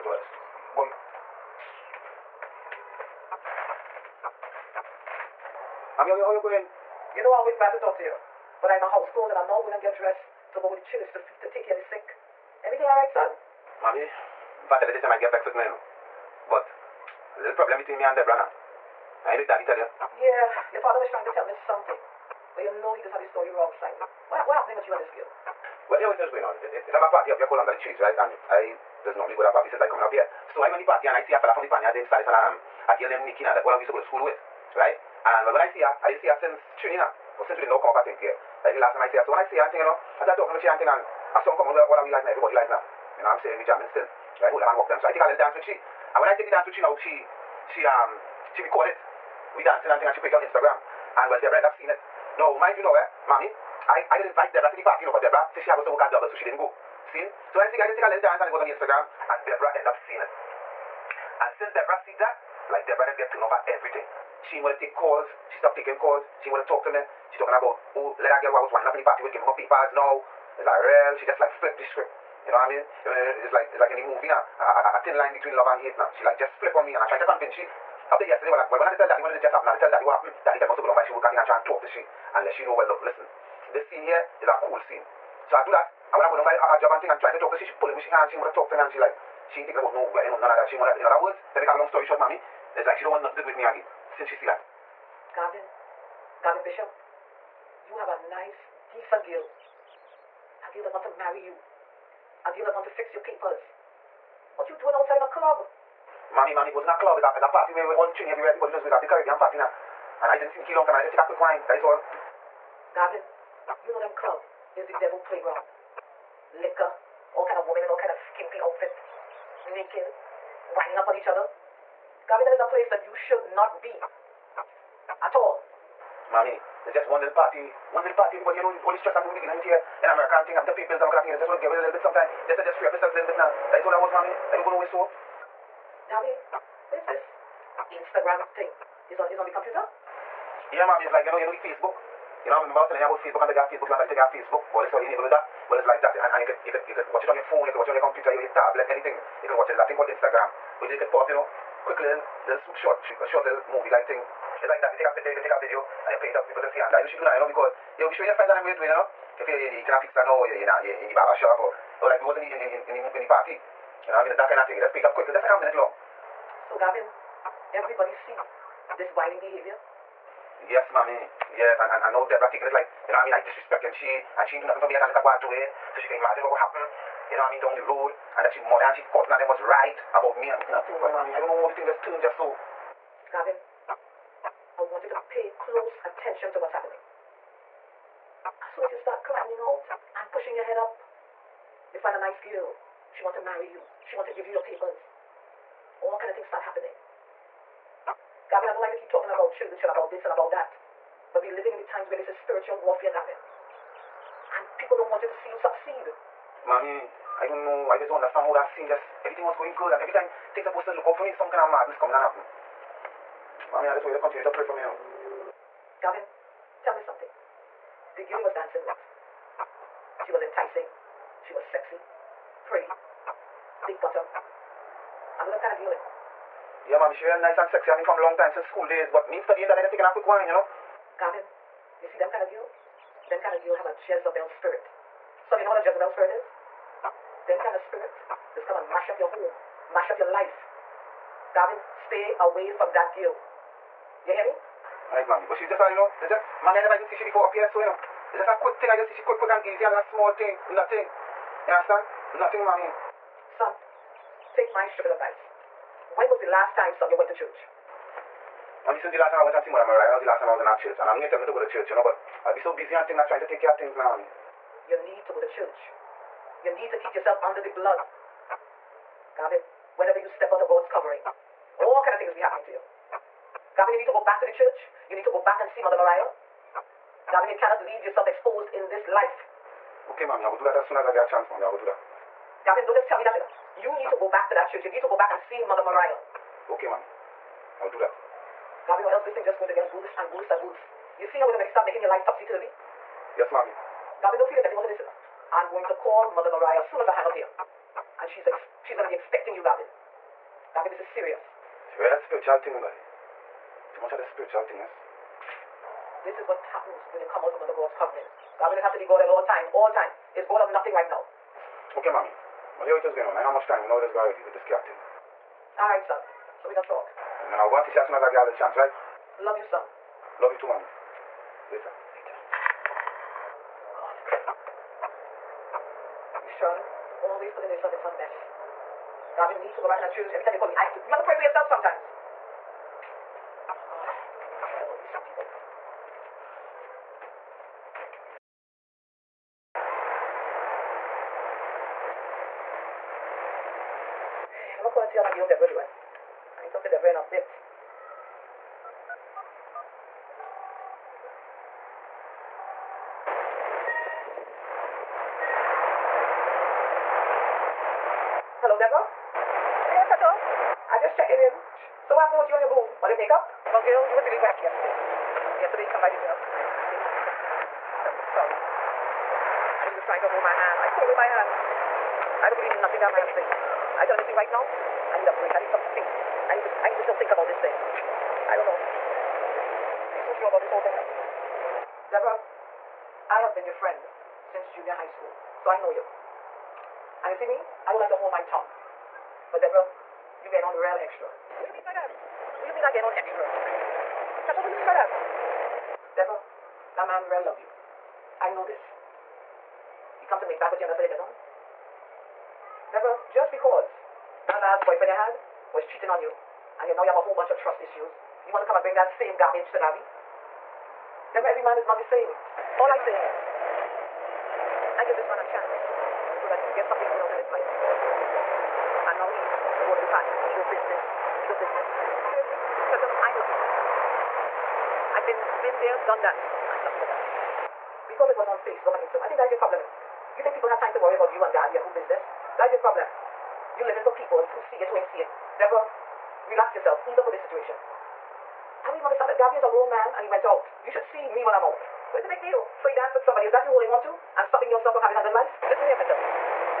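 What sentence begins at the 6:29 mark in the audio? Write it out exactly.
But Deborah, you getting on real extra.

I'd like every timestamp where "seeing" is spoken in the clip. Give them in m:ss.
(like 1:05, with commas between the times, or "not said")
0:51, 1:00.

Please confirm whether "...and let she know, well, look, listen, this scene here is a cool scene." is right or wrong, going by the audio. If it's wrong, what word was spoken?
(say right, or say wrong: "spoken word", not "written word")
right.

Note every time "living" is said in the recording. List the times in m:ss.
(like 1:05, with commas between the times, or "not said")
3:21, 7:13.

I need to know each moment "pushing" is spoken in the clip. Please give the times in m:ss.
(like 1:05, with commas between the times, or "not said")
3:10.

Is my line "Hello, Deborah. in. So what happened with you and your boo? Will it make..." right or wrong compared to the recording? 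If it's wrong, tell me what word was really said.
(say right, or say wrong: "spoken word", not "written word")
right.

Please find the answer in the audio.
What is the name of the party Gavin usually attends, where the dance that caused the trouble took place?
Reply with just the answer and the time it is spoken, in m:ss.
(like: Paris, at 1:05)
Under the Trees, at 0:27.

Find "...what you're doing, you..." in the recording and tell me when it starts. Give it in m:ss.
2:38.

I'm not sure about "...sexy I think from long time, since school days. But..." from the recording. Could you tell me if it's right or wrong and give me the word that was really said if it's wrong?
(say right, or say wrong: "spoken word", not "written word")
right.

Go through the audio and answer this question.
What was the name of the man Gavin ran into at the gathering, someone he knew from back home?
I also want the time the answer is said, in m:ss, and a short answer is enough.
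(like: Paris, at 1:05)
Saddis, at 0:32.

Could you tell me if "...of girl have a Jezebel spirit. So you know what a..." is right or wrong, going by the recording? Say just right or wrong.
right.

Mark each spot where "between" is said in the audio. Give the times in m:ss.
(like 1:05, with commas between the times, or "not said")
0:17, 1:15.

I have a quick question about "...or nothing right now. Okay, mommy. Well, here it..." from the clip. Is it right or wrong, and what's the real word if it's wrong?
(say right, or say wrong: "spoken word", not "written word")
right.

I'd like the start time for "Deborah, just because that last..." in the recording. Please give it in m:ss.
6:42.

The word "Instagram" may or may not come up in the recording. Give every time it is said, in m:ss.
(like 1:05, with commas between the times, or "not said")
0:50, 0:58, 2:17, 2:30, 7:08.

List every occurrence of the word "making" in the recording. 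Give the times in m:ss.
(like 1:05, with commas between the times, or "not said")
4:51.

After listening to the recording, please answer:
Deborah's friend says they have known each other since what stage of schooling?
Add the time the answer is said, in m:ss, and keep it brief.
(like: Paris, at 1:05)
junior high school, at 6:24.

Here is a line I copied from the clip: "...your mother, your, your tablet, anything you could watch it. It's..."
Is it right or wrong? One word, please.
wrong.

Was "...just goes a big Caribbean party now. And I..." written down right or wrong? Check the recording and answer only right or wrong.
right.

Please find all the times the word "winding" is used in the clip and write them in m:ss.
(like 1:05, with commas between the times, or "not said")
1:08, 2:00.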